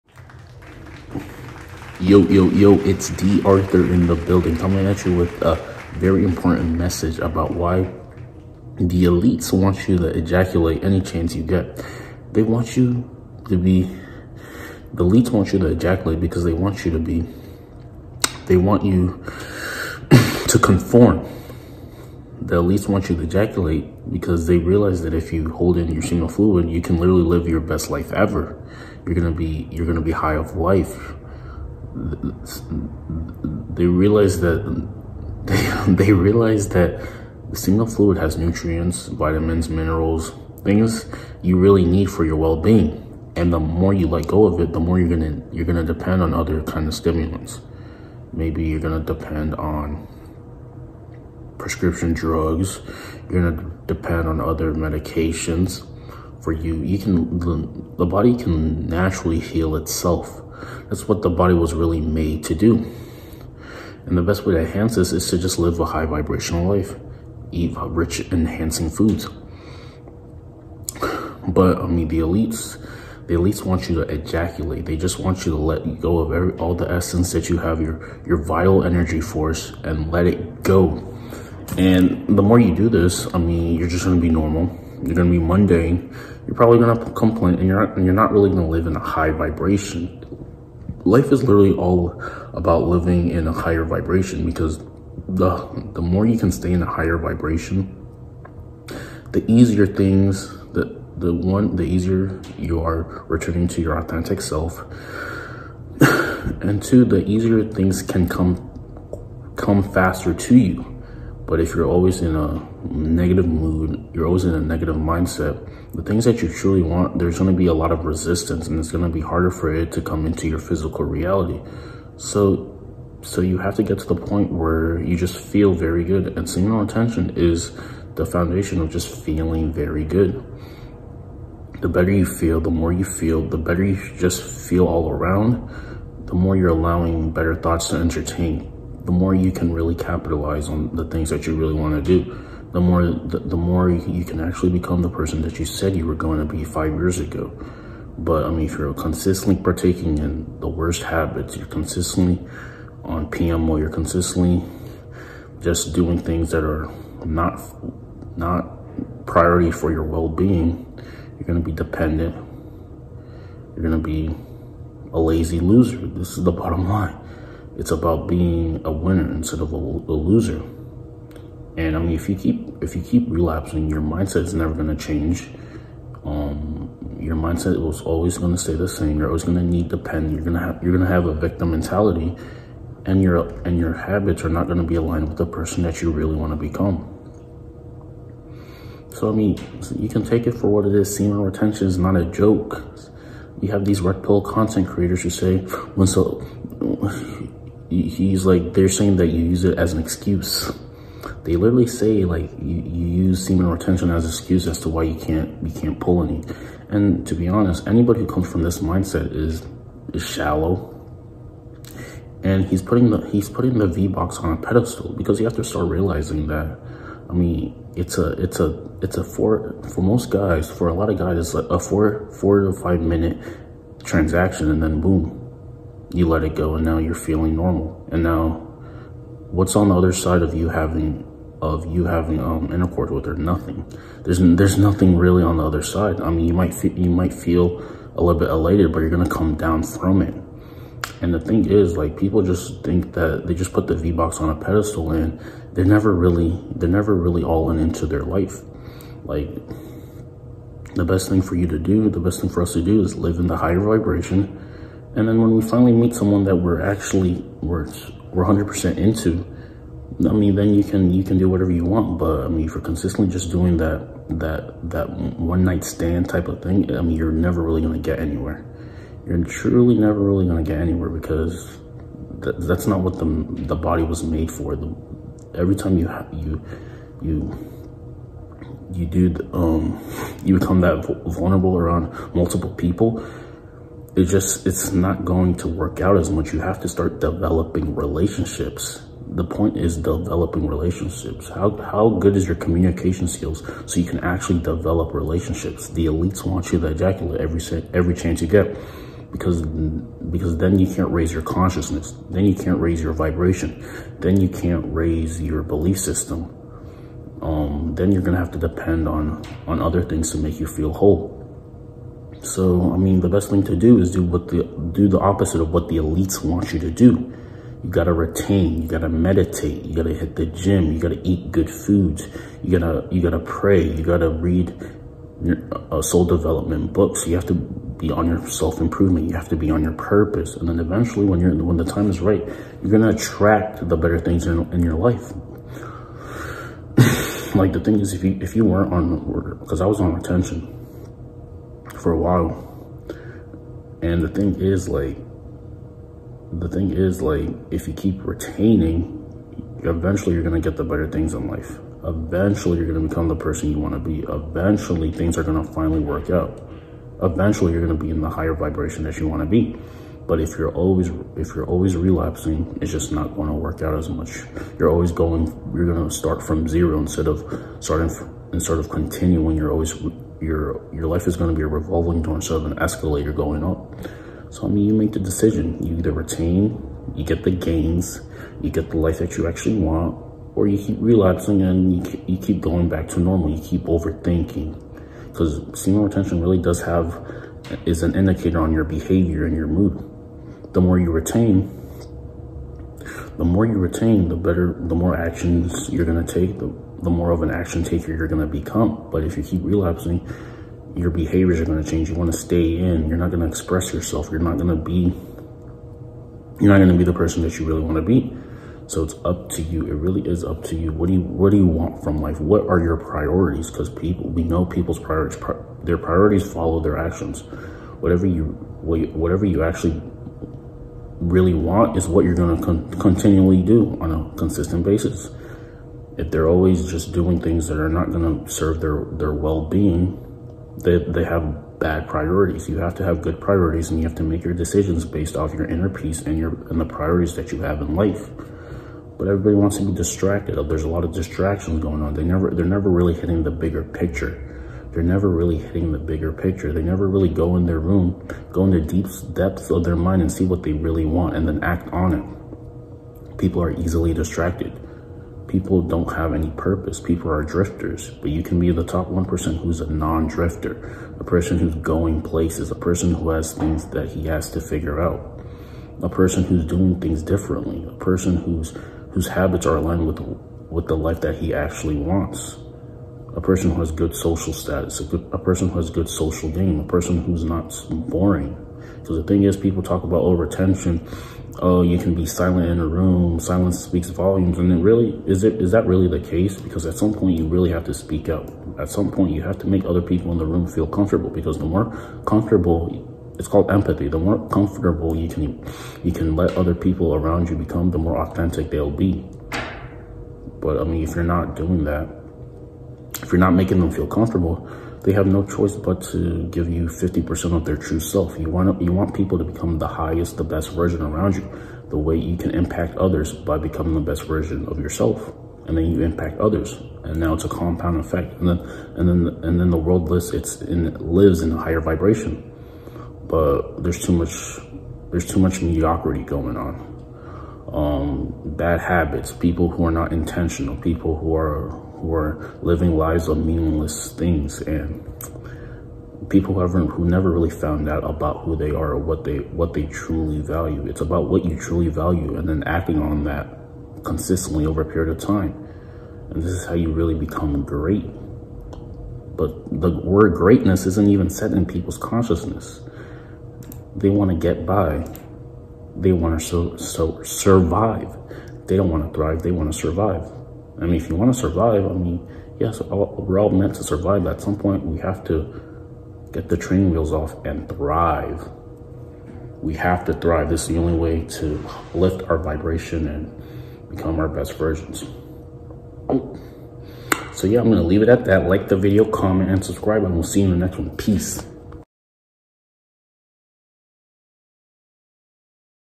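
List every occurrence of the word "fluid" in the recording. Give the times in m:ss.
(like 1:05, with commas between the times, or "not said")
0:26, 0:37.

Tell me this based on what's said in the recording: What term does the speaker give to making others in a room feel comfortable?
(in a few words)
Empathy.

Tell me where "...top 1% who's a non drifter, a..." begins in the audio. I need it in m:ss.
7:38.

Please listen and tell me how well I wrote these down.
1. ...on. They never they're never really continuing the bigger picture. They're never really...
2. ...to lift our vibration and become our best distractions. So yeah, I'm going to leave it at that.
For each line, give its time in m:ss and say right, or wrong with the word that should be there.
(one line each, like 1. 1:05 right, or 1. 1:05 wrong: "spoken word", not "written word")
1. 7:22 wrong: "hitting", not "continuing"
2. 9:31 wrong: "versions", not "distractions".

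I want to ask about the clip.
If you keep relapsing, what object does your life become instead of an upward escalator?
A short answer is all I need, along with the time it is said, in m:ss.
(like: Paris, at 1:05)
A revolving door, at 6:11.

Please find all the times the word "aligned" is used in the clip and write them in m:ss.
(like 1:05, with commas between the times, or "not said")
3:04, 7:49.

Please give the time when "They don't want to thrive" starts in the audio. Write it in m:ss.
9:18.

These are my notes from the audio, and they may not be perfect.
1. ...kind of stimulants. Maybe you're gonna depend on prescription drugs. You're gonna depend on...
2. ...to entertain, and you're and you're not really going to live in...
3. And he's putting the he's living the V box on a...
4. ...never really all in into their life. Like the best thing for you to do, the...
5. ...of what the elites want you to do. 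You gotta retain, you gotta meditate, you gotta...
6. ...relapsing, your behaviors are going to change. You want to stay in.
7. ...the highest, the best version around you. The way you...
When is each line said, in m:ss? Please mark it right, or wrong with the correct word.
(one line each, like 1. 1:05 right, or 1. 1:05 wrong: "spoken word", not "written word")
1. 0:46 right
2. 1:26 wrong: "complain", not "entertain"
3. 3:32 wrong: "putting", not "living"
4. 4:06 right
5. 5:15 right
6. 6:39 right
7. 8:29 right.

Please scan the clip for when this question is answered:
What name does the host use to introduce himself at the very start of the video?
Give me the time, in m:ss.
0:03.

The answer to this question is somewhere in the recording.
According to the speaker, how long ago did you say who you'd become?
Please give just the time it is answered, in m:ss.
2:26.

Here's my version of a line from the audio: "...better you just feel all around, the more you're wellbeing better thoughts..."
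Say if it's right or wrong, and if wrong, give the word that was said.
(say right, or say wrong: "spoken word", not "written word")
wrong: "allowing", not "wellbeing".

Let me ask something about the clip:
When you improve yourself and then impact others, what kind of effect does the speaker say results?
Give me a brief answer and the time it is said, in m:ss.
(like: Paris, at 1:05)
Compound effect, at 8:37.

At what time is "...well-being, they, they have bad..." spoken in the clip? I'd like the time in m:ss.
7:09.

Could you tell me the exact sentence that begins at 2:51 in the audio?
And I mean, if you keep if you keep relapsing, your mindset is never going to change.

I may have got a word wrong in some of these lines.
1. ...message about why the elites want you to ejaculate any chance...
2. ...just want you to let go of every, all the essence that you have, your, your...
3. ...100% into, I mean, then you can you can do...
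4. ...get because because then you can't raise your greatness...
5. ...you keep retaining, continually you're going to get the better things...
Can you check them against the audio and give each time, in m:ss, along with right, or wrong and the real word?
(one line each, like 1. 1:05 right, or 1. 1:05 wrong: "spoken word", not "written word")
1. 0:06 right
2. 1:14 right
3. 4:18 right
4. 4:58 wrong: "consciousness", not "greatness"
5. 5:47 wrong: "eventually", not "continually".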